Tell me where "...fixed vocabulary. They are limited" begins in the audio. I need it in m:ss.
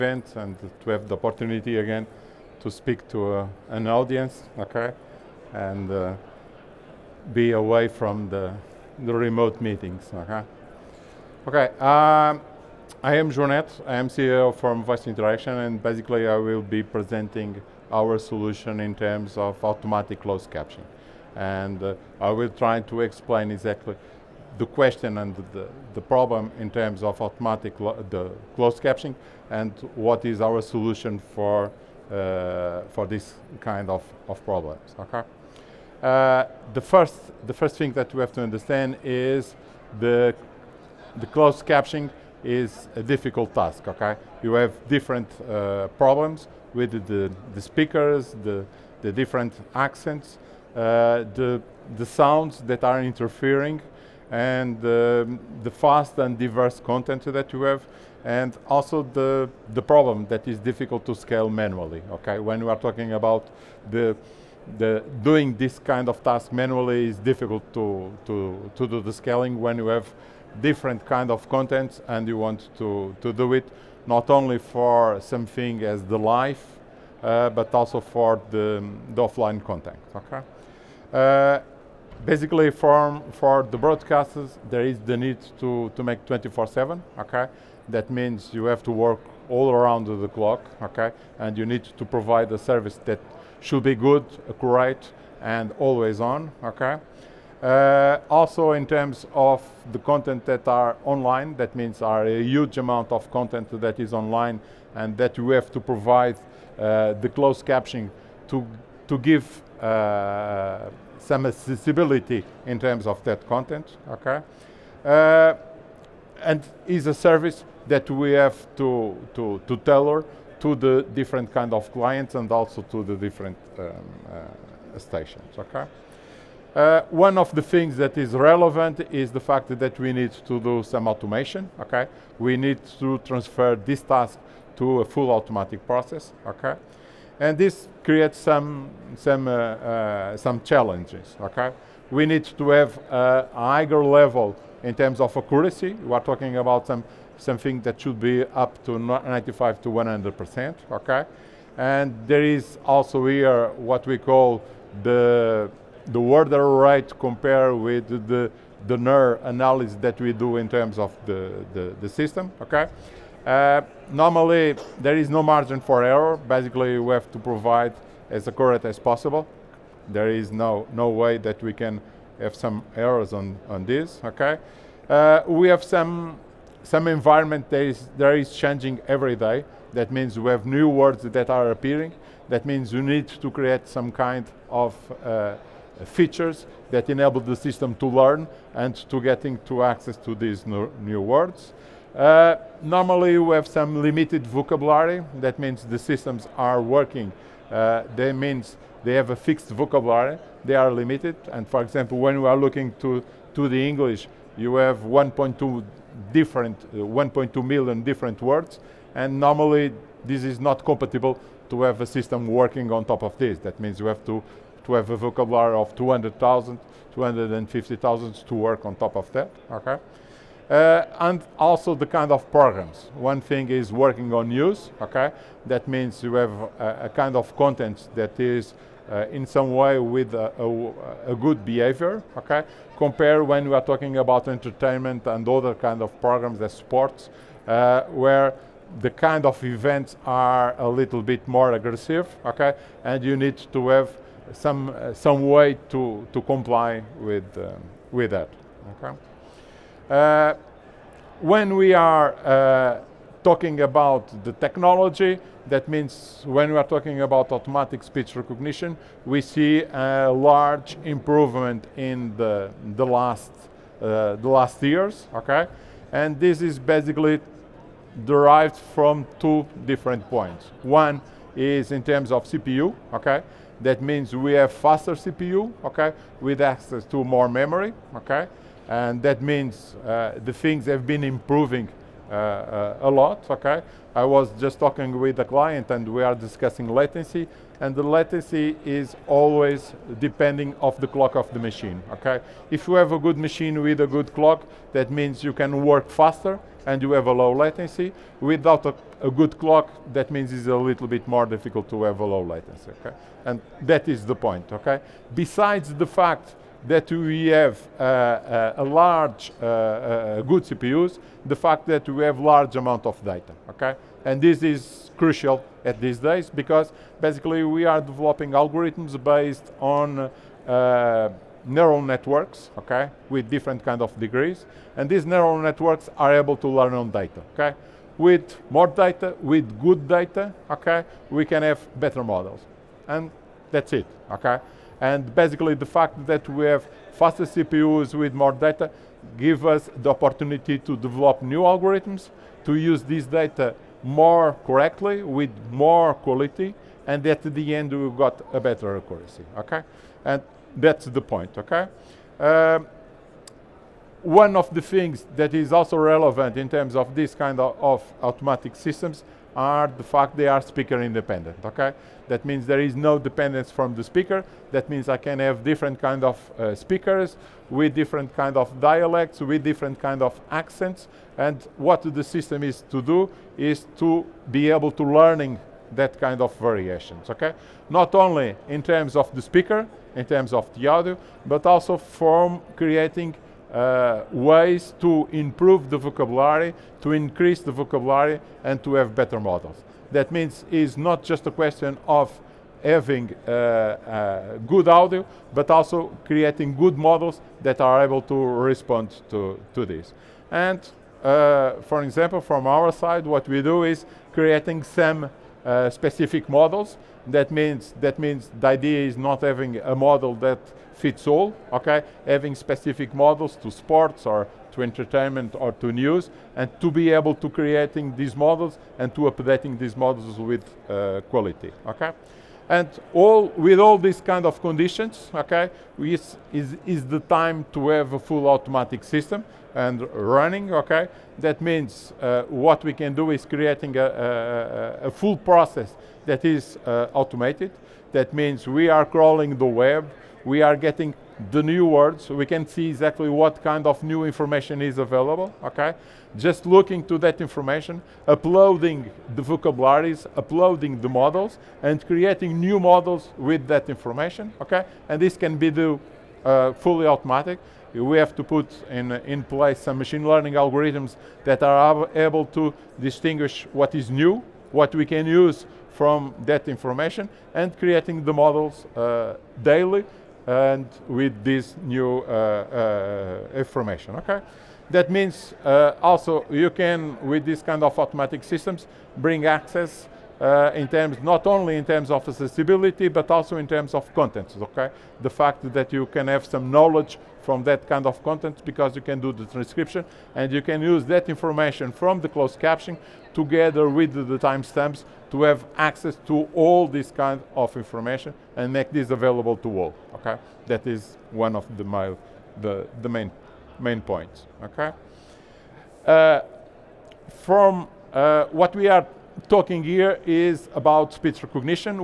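3:19.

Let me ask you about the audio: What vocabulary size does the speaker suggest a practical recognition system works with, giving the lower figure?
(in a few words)
200,000.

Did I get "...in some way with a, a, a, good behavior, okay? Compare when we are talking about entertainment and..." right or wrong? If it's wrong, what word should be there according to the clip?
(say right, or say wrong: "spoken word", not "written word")
right.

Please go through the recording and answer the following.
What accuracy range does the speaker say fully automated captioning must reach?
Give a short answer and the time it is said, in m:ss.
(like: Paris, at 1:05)
95 to 100 percent, at 2:28.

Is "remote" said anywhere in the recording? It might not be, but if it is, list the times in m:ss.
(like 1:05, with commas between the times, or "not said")
0:09.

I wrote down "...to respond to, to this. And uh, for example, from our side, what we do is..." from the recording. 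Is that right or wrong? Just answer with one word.
right.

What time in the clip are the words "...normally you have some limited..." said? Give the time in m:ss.
3:12.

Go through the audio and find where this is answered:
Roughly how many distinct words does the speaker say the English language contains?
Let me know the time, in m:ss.
3:26.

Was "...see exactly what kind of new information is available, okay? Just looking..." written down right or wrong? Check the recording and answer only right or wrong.
right.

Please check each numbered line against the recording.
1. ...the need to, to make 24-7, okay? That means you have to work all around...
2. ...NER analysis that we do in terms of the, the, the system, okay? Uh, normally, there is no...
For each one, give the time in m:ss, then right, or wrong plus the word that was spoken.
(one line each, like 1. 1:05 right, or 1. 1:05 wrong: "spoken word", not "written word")
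1. 1:24 right
2. 2:38 right.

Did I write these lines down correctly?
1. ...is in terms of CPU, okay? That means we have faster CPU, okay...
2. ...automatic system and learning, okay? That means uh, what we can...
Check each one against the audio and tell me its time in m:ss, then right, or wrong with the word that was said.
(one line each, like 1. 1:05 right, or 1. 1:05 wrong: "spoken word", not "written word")
1. 4:31 right
2. 7:08 wrong: "running", not "learning".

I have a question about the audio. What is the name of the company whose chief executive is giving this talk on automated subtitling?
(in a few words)
Voice Interaction.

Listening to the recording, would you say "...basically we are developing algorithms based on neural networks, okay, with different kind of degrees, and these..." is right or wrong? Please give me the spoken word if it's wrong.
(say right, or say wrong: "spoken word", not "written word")
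right.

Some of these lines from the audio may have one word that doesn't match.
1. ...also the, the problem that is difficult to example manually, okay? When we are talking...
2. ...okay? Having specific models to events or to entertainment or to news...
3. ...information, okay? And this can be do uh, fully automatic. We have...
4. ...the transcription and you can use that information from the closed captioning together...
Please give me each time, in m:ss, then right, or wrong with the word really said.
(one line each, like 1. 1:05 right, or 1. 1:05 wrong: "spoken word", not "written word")
1. 0:58 wrong: "scale", not "example"
2. 6:51 wrong: "sports", not "events"
3. 7:33 right
4. 8:09 right.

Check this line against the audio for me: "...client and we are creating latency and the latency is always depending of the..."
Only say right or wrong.
wrong.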